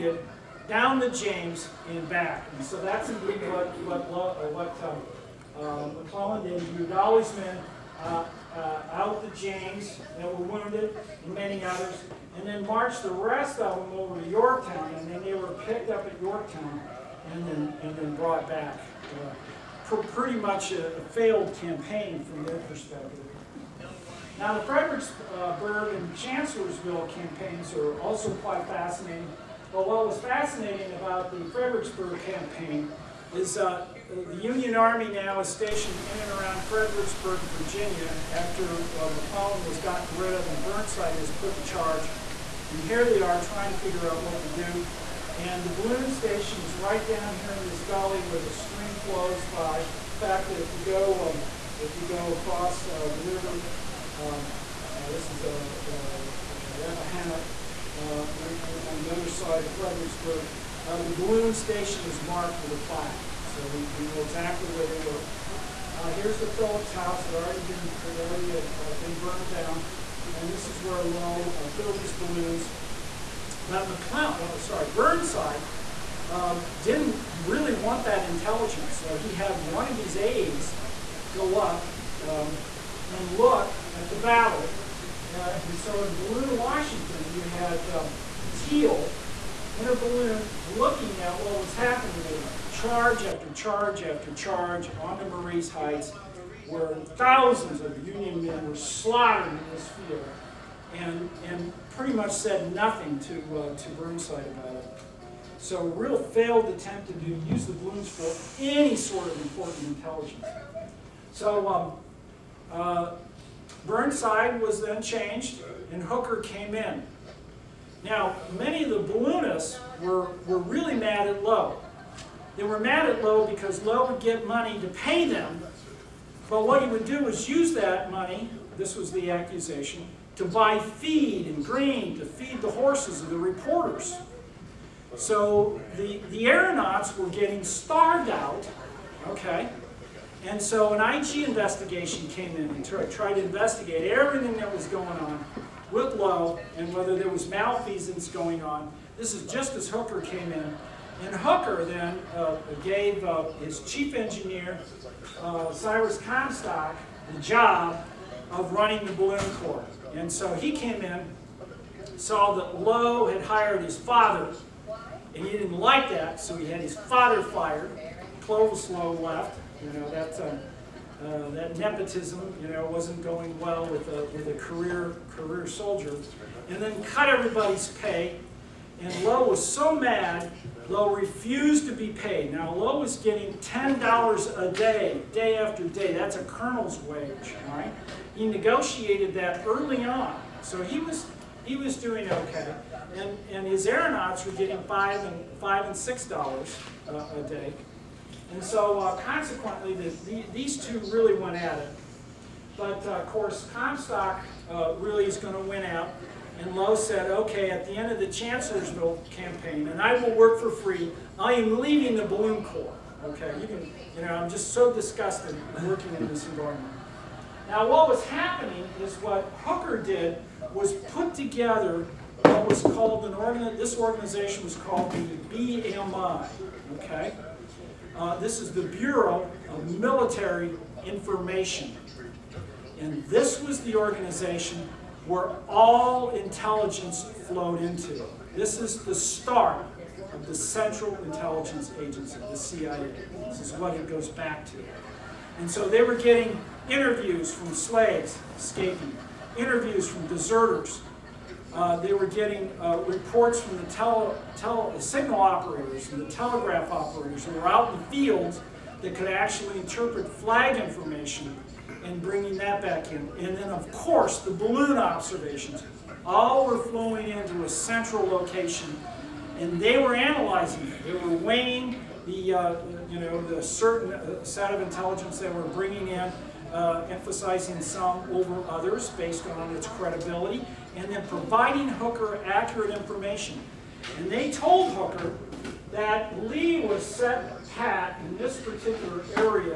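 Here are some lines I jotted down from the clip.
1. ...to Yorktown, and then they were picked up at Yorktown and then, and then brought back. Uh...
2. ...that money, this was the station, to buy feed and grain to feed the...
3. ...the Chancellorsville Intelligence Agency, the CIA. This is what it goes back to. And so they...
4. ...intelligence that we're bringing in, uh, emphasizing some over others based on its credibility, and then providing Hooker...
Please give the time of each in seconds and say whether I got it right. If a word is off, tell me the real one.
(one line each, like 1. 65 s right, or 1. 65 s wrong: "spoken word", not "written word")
1. 14 s right
2. 127 s wrong: "accusation", not "station"
3. 240 s wrong: "Central", not "Chancellorsville"
4. 274 s right.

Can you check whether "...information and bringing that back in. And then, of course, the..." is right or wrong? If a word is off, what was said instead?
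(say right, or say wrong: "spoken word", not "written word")
right.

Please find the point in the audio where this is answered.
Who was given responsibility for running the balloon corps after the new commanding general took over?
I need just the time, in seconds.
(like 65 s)
155 s.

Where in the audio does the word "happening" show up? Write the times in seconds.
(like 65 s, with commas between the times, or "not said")
91 s, 218 s.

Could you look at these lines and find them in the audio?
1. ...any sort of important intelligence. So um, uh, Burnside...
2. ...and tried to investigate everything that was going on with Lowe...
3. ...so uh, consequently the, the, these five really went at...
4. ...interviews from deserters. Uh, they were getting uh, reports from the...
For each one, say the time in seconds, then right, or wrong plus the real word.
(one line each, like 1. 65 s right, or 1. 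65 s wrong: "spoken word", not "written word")
1. 108 s right
2. 142 s right
3. 198 s wrong: "two", not "five"
4. 249 s right.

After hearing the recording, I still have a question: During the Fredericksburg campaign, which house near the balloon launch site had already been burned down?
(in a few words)
Phillips house.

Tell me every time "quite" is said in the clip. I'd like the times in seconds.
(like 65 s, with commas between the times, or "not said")
28 s.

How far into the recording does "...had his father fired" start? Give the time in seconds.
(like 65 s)
166 s.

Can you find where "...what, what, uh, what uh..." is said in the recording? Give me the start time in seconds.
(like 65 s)
3 s.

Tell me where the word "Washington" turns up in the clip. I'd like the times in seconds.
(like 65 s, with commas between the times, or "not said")
86 s.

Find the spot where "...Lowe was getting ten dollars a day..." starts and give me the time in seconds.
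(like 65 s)
182 s.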